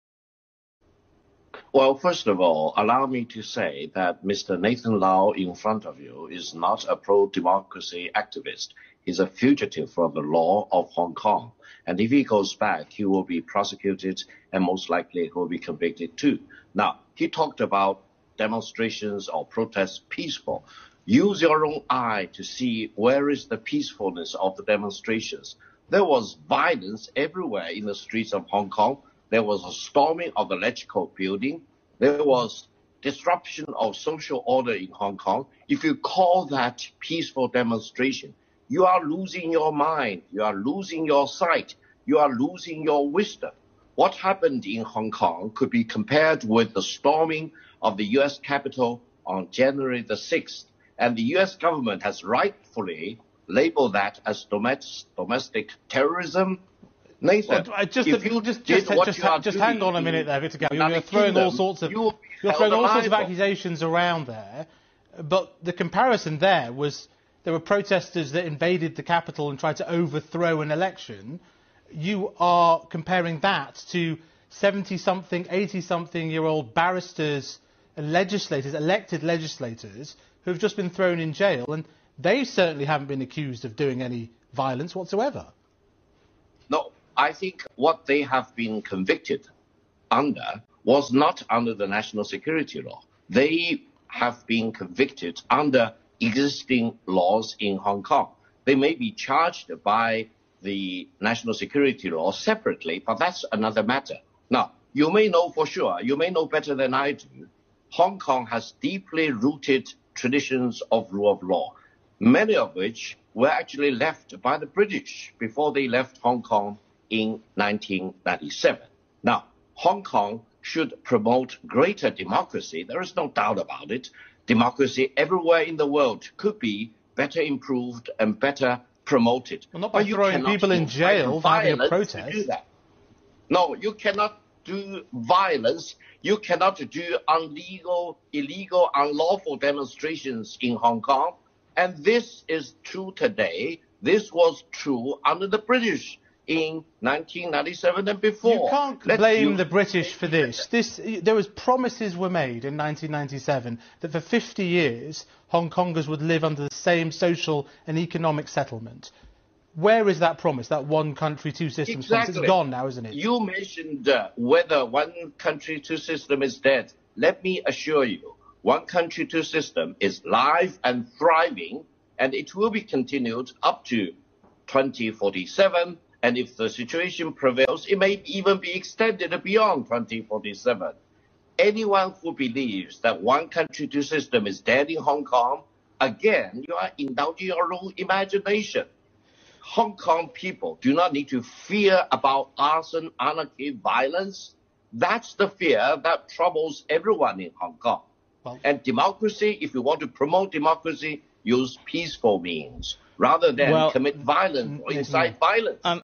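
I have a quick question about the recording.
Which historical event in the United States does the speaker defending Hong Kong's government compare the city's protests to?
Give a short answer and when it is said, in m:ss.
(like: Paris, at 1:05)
storming of the US Capitol, at 0:46.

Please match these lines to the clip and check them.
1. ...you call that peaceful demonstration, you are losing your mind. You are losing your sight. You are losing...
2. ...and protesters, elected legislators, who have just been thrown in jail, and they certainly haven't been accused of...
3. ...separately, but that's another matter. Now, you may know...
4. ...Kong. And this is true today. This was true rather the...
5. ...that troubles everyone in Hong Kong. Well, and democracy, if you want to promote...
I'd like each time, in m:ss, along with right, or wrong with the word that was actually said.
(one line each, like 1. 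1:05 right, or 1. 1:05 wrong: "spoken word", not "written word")
1. 0:35 right
2. 1:17 wrong: "legislators", not "protesters"
3. 1:42 right
4. 2:21 wrong: "under", not "rather"
5. 3:16 right.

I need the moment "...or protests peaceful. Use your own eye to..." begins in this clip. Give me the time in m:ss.
0:19.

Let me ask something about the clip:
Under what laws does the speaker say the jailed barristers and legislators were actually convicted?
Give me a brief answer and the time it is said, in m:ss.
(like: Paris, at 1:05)
existing laws in Hong Kong, at 1:36.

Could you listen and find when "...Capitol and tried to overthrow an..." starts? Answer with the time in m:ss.
1:09.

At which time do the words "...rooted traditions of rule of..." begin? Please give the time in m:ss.
1:49.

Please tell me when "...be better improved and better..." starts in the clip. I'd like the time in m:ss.
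2:06.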